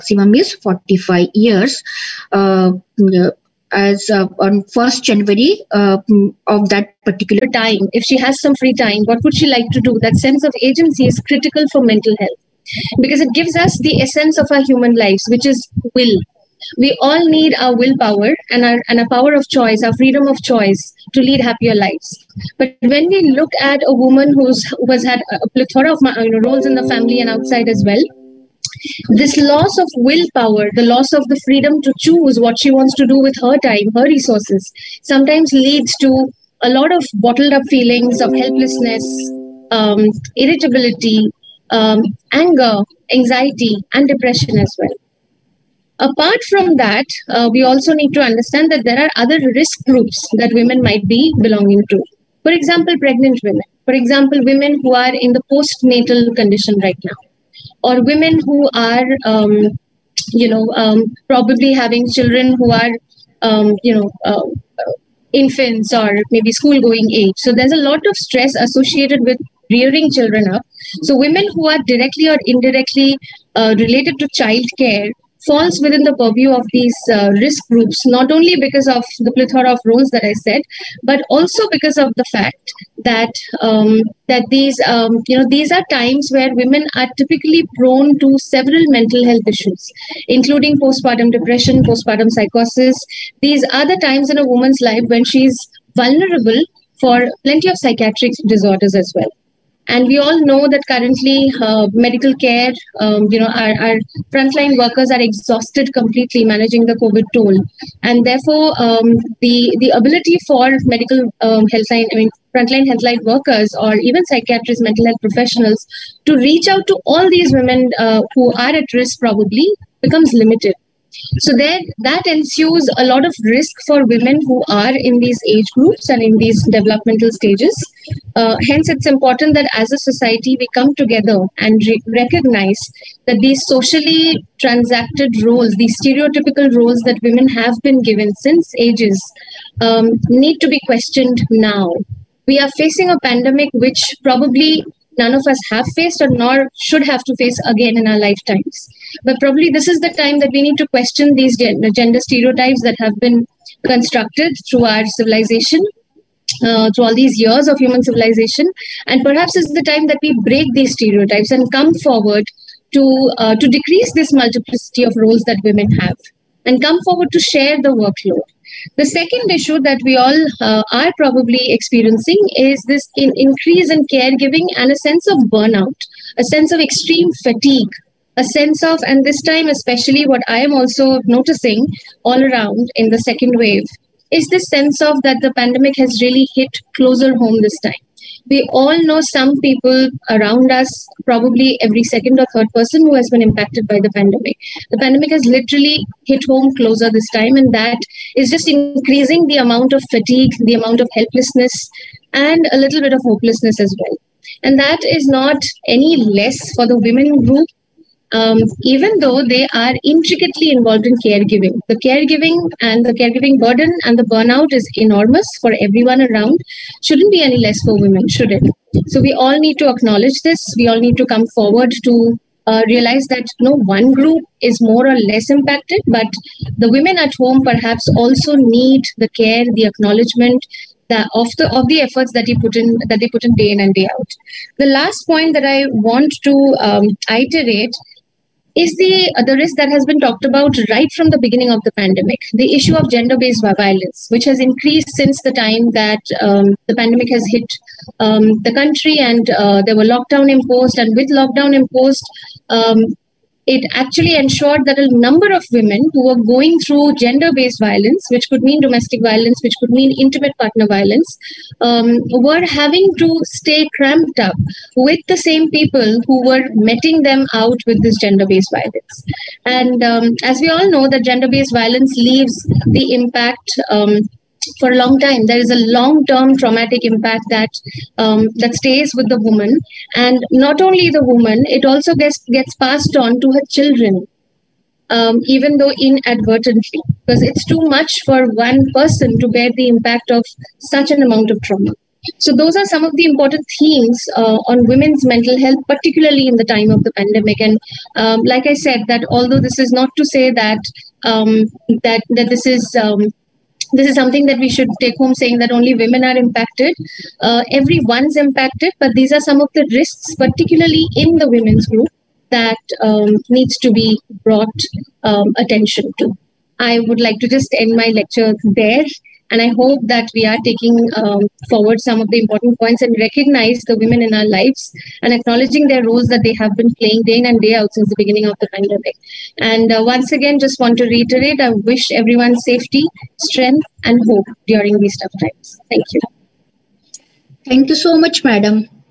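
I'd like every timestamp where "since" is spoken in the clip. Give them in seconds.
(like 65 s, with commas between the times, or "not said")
138 s, 245 s, 327 s.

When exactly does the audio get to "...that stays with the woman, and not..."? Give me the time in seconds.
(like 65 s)
278 s.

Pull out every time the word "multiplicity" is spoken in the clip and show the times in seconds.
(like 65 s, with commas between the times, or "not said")
164 s.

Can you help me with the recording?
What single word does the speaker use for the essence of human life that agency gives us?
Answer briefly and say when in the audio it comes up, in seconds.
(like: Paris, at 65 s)
will, at 15 s.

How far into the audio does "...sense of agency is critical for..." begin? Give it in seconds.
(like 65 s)
10 s.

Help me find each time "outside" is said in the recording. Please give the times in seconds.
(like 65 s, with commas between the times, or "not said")
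27 s.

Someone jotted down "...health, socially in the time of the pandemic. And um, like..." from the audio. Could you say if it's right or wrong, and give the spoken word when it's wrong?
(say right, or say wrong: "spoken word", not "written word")
wrong: "particularly", not "socially".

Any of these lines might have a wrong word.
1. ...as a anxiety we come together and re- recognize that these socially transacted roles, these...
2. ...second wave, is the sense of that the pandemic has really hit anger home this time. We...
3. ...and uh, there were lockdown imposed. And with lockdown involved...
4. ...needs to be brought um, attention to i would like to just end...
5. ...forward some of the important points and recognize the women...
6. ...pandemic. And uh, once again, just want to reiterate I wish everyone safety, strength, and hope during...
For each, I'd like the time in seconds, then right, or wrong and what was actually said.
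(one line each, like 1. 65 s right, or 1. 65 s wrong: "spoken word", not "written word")
1. 129 s wrong: "society", not "anxiety"
2. 183 s wrong: "closer", not "anger"
3. 249 s wrong: "imposed", not "involved"
4. 313 s right
5. 321 s right
6. 328 s right.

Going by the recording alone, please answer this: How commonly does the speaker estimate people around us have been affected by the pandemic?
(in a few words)
second or third.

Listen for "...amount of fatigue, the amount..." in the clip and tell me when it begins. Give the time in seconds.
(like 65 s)
199 s.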